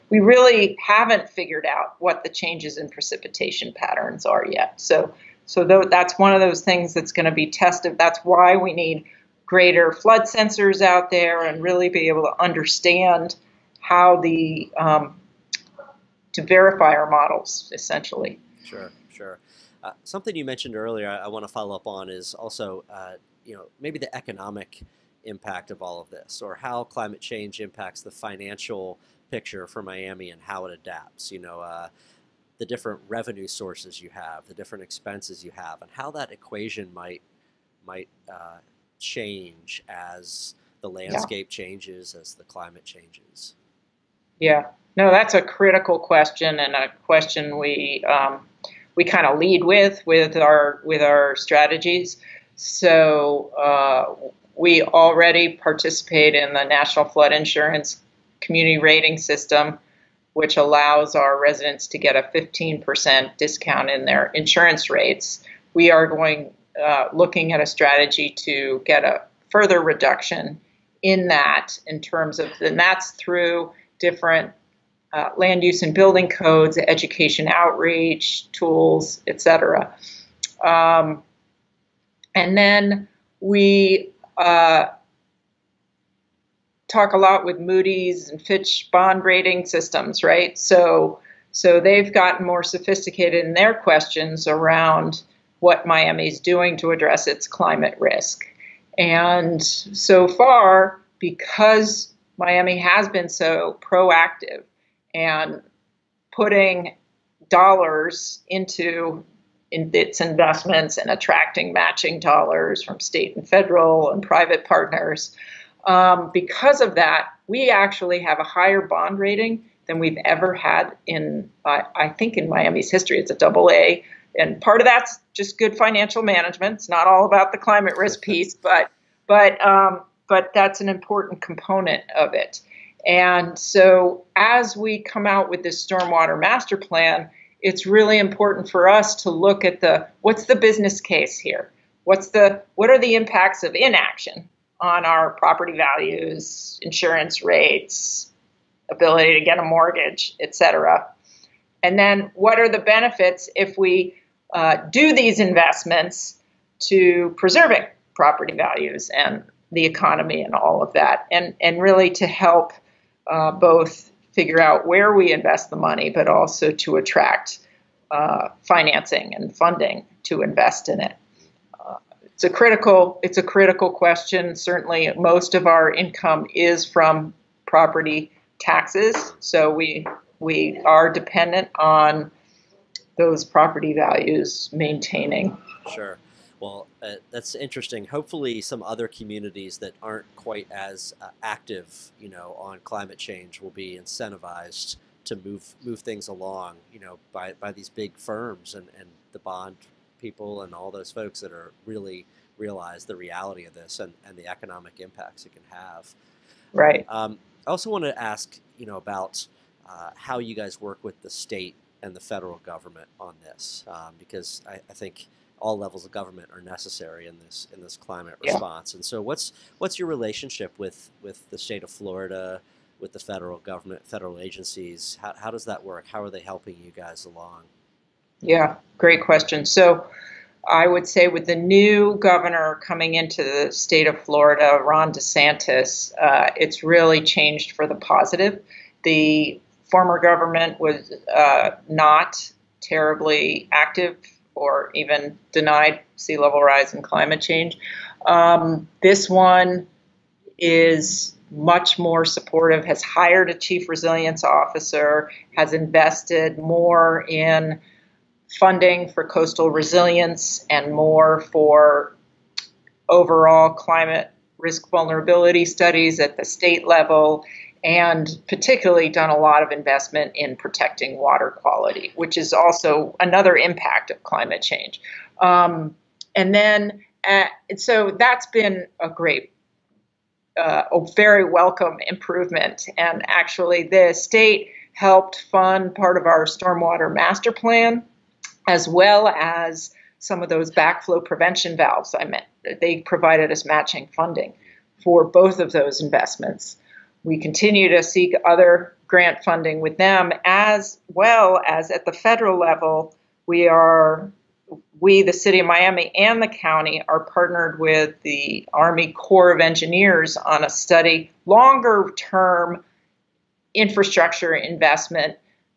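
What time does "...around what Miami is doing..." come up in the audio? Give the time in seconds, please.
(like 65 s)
94 s.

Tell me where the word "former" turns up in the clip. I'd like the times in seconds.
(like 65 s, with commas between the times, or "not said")
239 s.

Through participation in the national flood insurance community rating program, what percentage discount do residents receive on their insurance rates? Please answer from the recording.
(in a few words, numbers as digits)
15%.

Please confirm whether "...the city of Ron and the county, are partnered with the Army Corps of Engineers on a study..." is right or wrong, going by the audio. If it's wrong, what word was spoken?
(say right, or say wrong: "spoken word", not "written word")
wrong: "Miami", not "Ron".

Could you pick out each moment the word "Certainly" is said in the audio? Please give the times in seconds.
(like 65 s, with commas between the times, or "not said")
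174 s.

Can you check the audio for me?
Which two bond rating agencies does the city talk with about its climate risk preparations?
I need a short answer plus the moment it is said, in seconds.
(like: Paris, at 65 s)
Moody's and Fitch, at 87 s.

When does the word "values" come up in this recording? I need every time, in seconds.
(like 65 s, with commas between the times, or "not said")
145 s, 158 s, 183 s.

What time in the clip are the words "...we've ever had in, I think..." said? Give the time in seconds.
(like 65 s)
119 s.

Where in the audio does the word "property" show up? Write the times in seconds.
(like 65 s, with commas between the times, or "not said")
145 s, 158 s, 177 s, 183 s.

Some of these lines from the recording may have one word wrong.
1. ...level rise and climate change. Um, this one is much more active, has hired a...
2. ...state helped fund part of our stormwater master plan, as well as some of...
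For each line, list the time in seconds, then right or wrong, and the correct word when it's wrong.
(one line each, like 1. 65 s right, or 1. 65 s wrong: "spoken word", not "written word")
1. 246 s wrong: "supportive", not "active"
2. 284 s right.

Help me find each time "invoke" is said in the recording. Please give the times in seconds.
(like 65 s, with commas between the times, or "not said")
not said.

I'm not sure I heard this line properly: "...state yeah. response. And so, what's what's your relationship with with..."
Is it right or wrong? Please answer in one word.
wrong.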